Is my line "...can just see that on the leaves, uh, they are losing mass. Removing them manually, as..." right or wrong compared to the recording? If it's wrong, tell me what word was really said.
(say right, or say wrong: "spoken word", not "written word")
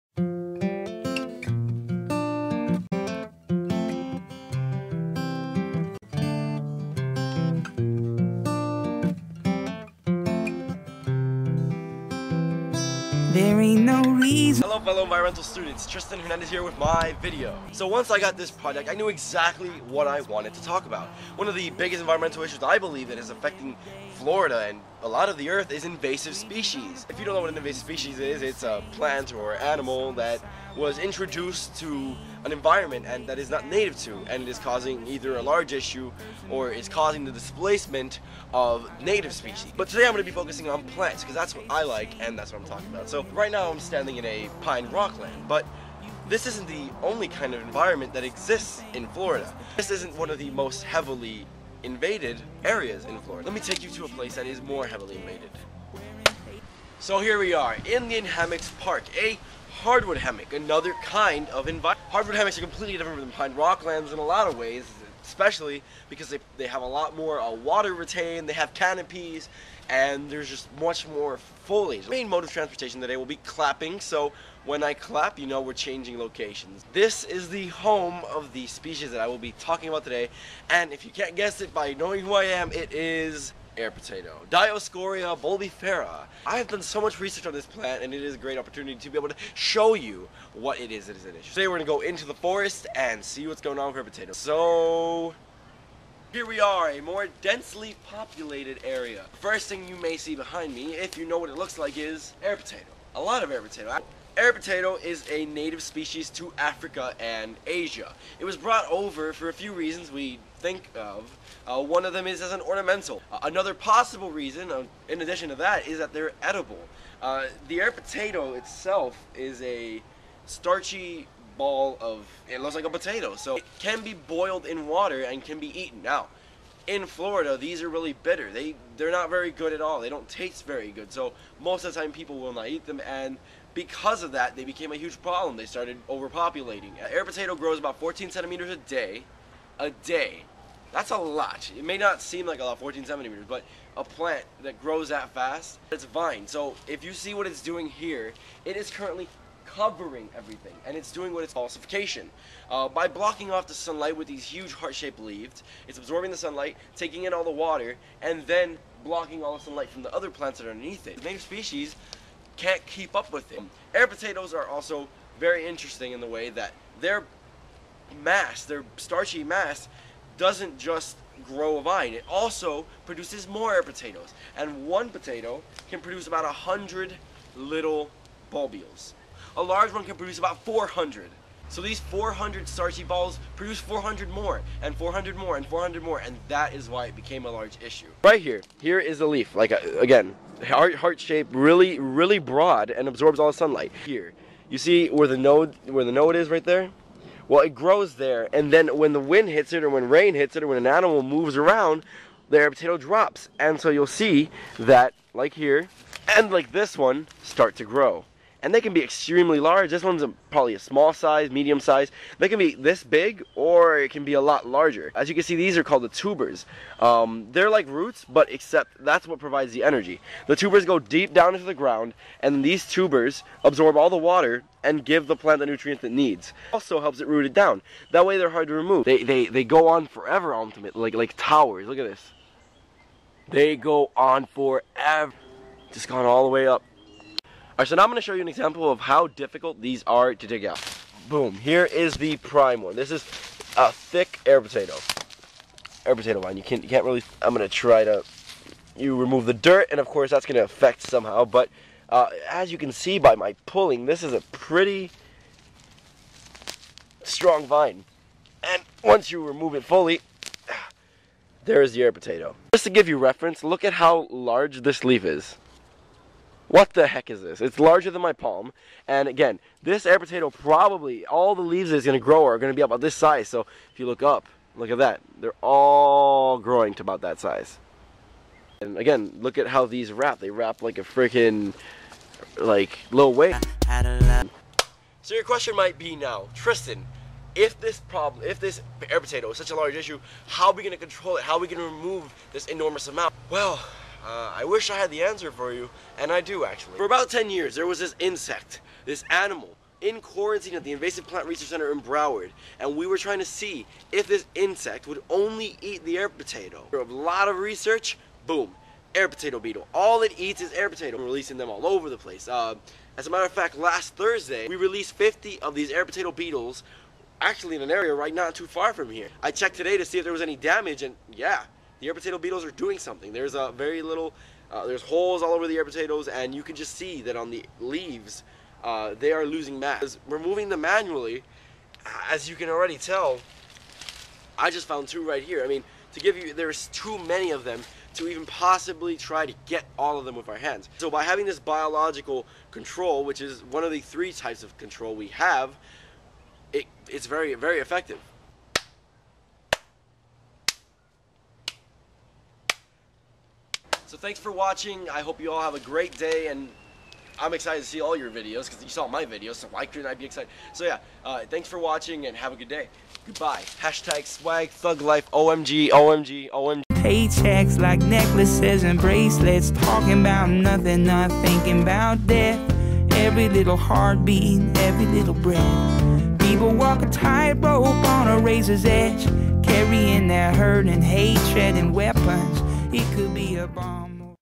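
right.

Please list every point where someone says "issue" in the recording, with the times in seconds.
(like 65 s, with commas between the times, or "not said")
22 s, 35 s, 91 s, 187 s, 289 s.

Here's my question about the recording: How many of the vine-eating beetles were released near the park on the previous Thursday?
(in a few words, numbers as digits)
50.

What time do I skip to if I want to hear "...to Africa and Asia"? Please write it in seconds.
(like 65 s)
106 s.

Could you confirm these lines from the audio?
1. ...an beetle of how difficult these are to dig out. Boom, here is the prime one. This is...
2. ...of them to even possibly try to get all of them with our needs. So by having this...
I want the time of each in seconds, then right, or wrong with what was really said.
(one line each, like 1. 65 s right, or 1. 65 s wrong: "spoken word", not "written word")
1. 238 s wrong: "example", not "beetle"
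2. 337 s wrong: "hands", not "needs".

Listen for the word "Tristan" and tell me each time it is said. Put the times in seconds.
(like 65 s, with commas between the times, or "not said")
15 s, 286 s.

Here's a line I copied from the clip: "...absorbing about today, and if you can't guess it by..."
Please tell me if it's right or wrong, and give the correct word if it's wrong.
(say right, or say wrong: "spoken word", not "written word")
wrong: "talking", not "absorbing".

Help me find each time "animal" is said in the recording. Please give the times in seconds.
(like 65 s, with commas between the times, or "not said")
29 s, 200 s, 299 s.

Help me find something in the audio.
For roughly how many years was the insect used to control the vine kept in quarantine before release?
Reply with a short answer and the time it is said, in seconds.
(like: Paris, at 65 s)
10 years, at 297 s.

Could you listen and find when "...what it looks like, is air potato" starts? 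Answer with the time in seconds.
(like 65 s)
101 s.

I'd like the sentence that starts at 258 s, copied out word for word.
And once you remove it fully, there is the air potato.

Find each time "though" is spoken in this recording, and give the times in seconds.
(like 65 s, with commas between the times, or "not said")
not said.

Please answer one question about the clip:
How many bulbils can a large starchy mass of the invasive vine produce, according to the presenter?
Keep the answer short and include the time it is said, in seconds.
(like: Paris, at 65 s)
400, at 180 s.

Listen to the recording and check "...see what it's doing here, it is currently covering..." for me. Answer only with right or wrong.
right.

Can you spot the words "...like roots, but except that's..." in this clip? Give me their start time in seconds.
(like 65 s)
217 s.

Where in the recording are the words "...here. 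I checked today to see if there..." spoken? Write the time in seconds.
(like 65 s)
319 s.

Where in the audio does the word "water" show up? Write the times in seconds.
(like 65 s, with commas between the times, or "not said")
67 s, 124 s, 157 s, 224 s.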